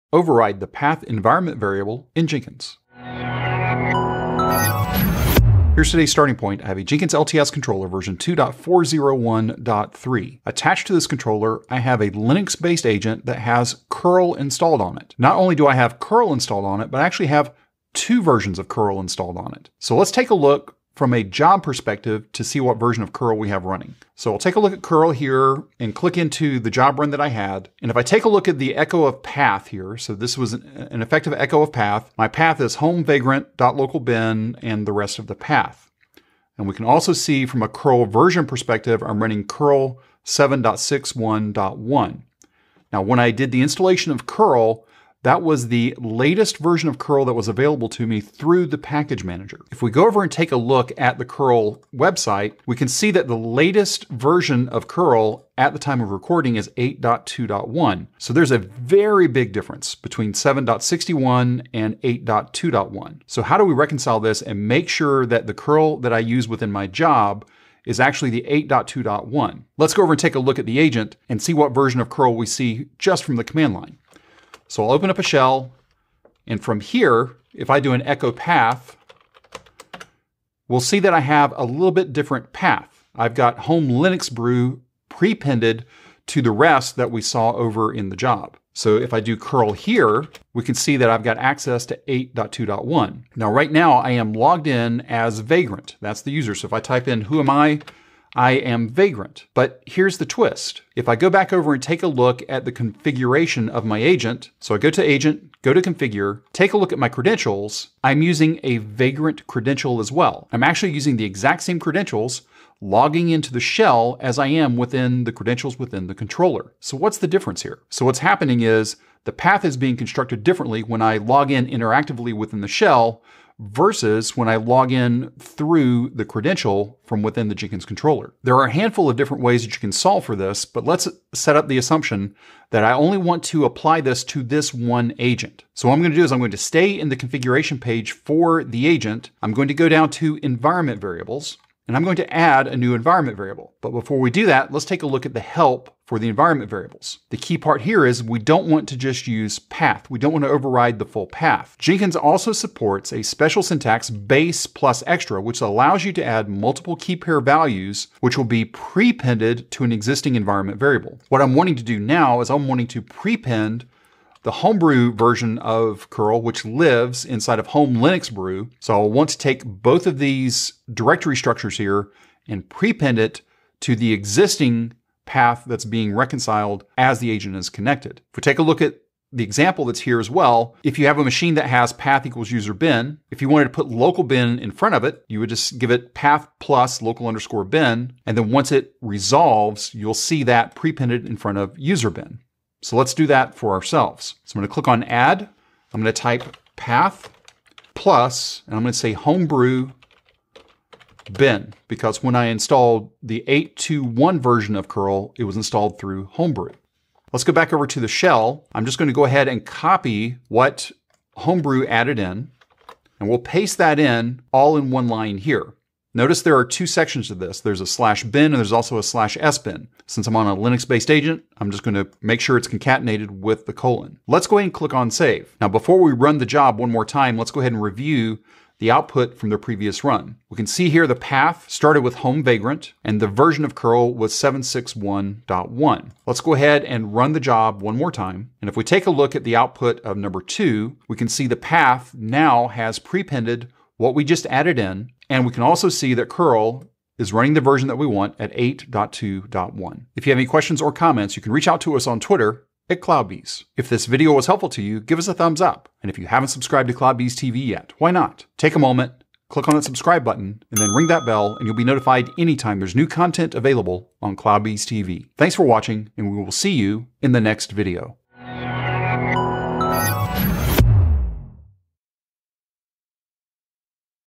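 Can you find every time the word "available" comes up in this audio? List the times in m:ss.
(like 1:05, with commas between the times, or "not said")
0:47, 4:23.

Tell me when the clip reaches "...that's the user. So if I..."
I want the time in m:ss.
1:35.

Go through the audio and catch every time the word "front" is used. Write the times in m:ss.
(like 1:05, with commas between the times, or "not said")
3:04, 3:11.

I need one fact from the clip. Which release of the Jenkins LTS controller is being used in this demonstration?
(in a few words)
2.401.3.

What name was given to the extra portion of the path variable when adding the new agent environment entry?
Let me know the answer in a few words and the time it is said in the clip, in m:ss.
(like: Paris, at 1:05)
homebrew bin, at 3:19.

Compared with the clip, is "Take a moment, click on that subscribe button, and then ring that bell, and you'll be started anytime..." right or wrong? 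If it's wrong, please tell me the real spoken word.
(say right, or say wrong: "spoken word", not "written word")
wrong: "notified", not "started".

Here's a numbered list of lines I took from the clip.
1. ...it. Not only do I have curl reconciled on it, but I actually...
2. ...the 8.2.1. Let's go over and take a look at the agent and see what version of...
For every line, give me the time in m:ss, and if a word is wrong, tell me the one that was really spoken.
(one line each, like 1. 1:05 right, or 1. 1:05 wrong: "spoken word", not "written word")
1. 0:14 wrong: "installed", not "reconciled"
2. 1:08 right.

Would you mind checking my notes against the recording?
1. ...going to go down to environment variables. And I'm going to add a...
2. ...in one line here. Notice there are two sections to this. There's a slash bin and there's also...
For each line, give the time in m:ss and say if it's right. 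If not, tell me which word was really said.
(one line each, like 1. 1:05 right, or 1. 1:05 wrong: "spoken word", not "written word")
1. 2:19 right
2. 3:34 right.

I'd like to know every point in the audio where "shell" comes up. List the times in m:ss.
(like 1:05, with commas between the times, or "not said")
1:15, 1:53, 2:02, 3:28.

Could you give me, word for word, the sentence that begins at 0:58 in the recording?
So there's a very big difference between 7.61 and 8.2.1.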